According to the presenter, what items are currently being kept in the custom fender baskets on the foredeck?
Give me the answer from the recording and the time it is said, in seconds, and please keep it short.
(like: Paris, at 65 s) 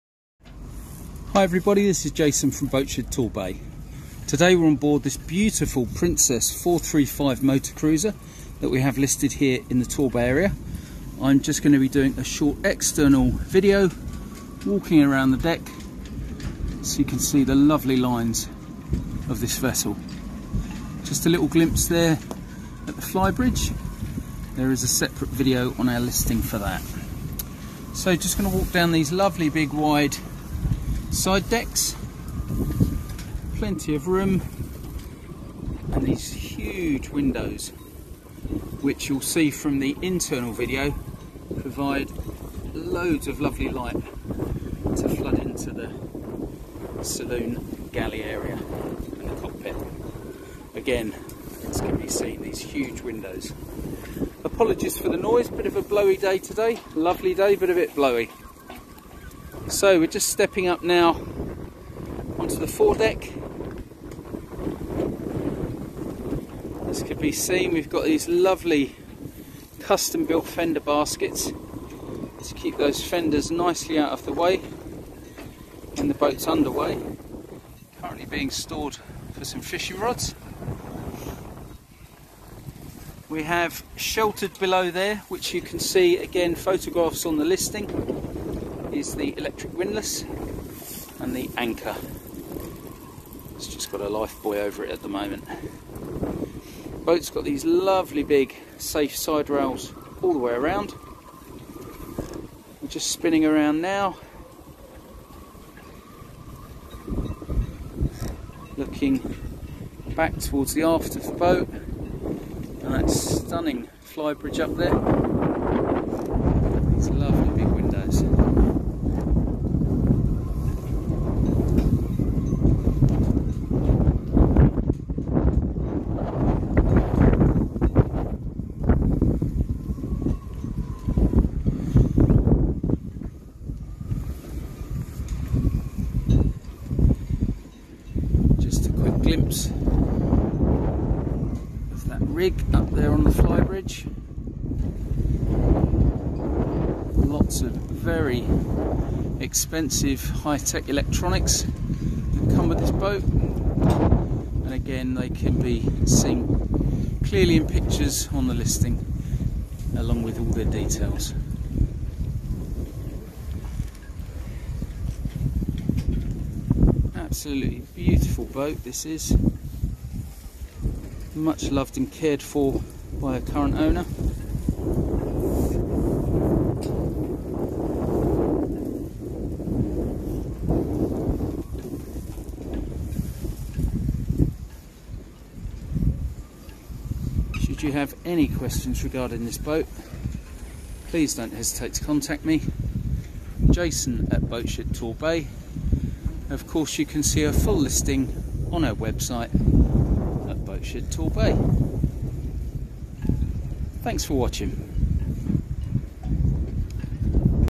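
Fishing rods, at 79 s.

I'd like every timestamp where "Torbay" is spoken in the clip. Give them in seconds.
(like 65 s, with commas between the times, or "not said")
3 s, 9 s, 194 s, 201 s.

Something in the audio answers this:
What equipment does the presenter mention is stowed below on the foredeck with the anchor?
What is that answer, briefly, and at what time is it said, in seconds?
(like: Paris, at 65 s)
Electric windlass, at 89 s.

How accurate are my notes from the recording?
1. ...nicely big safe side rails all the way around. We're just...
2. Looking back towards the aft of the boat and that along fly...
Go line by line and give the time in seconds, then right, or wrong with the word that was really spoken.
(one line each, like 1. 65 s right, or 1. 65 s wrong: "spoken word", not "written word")
1. 97 s wrong: "lovely", not "nicely"
2. 108 s wrong: "stunning", not "along".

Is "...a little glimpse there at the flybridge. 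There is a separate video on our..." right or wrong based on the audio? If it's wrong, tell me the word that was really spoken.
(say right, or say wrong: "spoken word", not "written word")
right.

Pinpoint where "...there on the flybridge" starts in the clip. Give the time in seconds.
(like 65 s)
142 s.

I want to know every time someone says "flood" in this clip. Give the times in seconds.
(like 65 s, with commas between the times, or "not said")
45 s.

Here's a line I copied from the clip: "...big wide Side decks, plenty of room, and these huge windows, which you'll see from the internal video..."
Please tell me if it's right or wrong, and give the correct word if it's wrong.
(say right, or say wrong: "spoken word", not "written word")
right.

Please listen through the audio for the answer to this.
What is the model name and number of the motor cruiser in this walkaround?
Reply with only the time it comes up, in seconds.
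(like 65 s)
5 s.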